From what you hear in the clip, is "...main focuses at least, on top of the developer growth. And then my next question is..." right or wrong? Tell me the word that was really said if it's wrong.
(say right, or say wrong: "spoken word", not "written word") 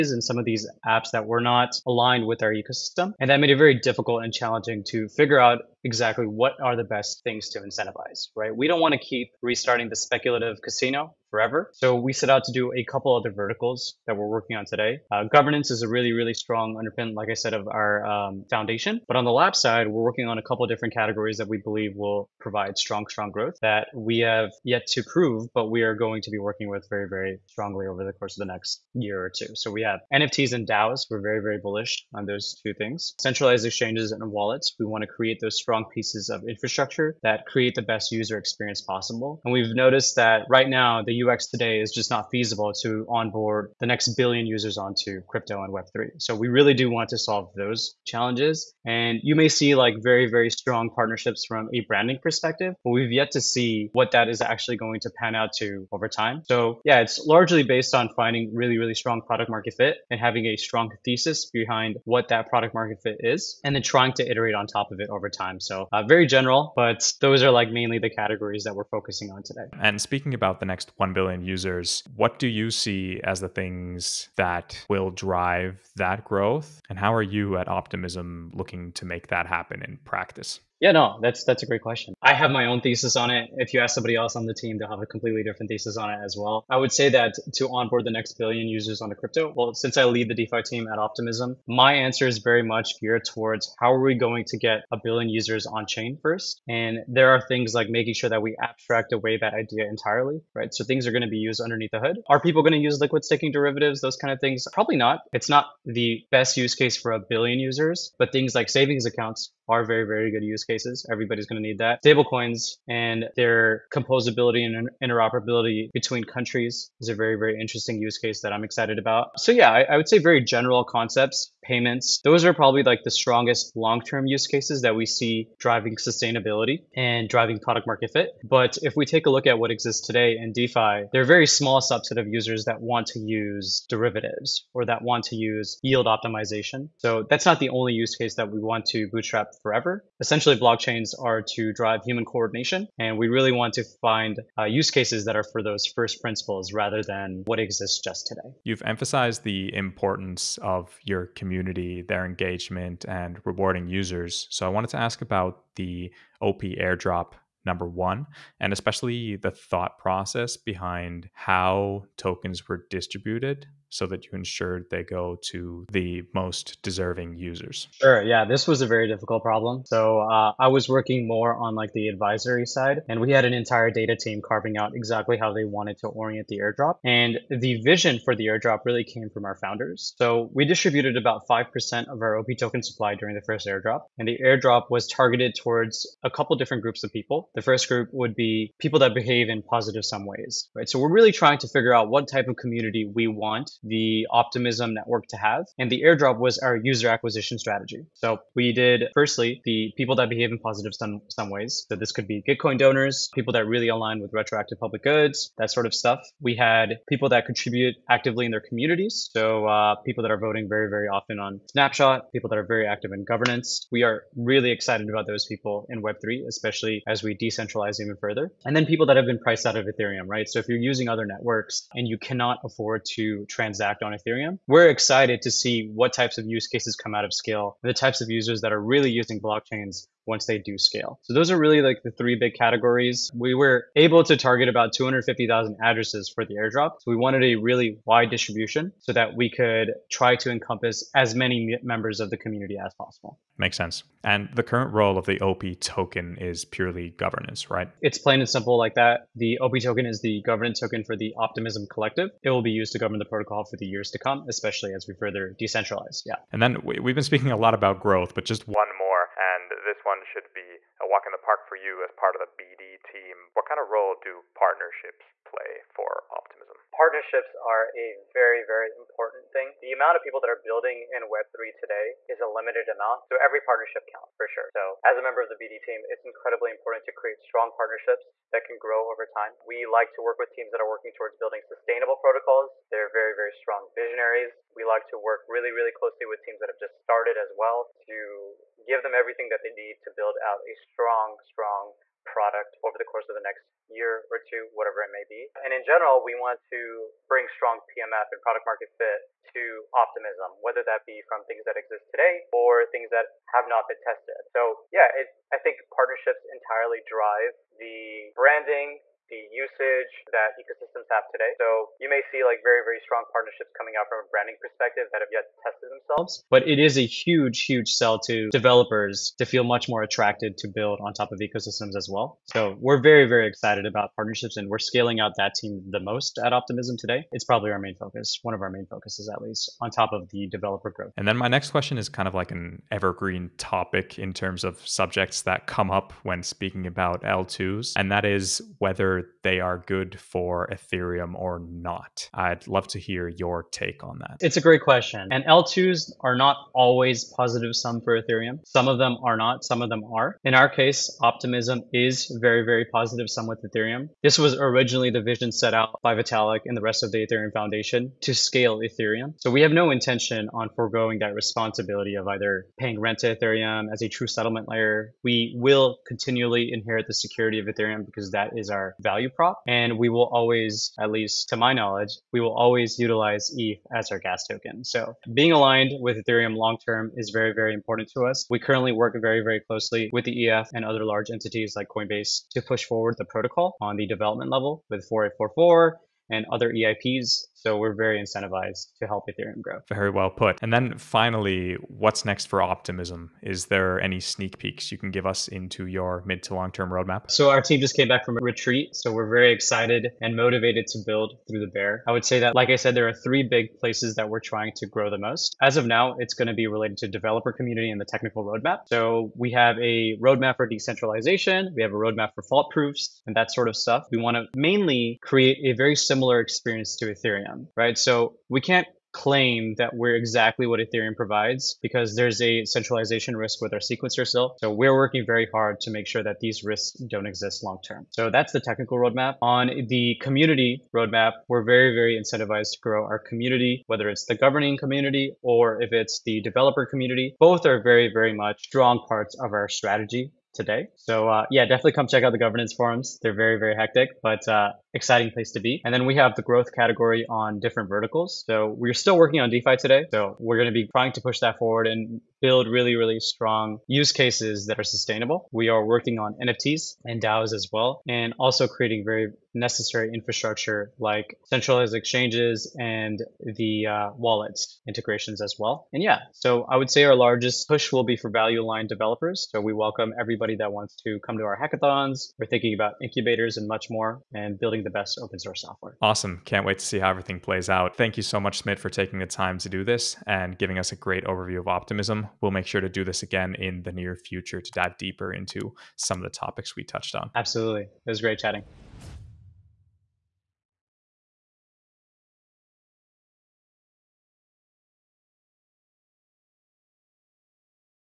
right.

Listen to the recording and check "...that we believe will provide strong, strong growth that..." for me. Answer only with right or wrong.
right.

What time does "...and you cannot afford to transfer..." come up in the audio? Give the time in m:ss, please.
3:41.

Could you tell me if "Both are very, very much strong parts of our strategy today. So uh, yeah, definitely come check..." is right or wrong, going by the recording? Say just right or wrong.
right.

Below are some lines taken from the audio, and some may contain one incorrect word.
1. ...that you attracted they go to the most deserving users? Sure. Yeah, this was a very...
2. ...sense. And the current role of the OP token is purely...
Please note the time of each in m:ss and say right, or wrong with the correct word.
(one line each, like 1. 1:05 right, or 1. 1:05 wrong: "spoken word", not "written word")
1. 2:44 wrong: "ensured", not "attracted"
2. 4:03 right.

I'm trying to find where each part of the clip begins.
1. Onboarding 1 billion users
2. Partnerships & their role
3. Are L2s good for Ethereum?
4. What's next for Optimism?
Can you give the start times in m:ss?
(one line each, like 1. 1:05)
1. 1:08
2. 4:15
3. 5:29
4. 6:29.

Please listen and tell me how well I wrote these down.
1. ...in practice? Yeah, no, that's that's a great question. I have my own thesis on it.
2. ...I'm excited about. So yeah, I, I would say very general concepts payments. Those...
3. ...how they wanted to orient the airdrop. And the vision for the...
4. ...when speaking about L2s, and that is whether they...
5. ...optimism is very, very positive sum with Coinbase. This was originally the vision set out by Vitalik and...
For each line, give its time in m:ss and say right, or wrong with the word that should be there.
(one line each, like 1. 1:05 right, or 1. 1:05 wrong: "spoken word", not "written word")
1. 1:19 right
2. 1:58 right
3. 2:55 right
4. 5:36 right
5. 5:51 wrong: "Ethereum", not "Coinbase".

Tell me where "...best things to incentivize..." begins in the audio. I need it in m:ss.
0:06.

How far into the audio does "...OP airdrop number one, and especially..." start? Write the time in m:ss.
2:36.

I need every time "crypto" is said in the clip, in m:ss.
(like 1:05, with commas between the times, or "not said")
0:45, 1:29.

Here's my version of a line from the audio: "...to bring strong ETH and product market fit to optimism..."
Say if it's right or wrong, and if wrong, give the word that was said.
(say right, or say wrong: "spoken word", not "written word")
wrong: "PMF", not "ETH".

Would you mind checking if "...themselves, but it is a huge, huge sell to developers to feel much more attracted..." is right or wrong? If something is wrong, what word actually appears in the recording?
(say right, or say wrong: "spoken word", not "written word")
right.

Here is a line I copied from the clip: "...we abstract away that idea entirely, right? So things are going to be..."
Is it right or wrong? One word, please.
right.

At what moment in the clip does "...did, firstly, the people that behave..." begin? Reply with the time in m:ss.
3:18.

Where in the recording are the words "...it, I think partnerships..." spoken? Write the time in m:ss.
5:05.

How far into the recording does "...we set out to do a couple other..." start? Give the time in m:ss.
0:11.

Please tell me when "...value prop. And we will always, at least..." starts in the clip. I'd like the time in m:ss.
6:09.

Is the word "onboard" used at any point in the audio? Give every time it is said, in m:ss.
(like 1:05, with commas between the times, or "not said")
0:43, 1:27.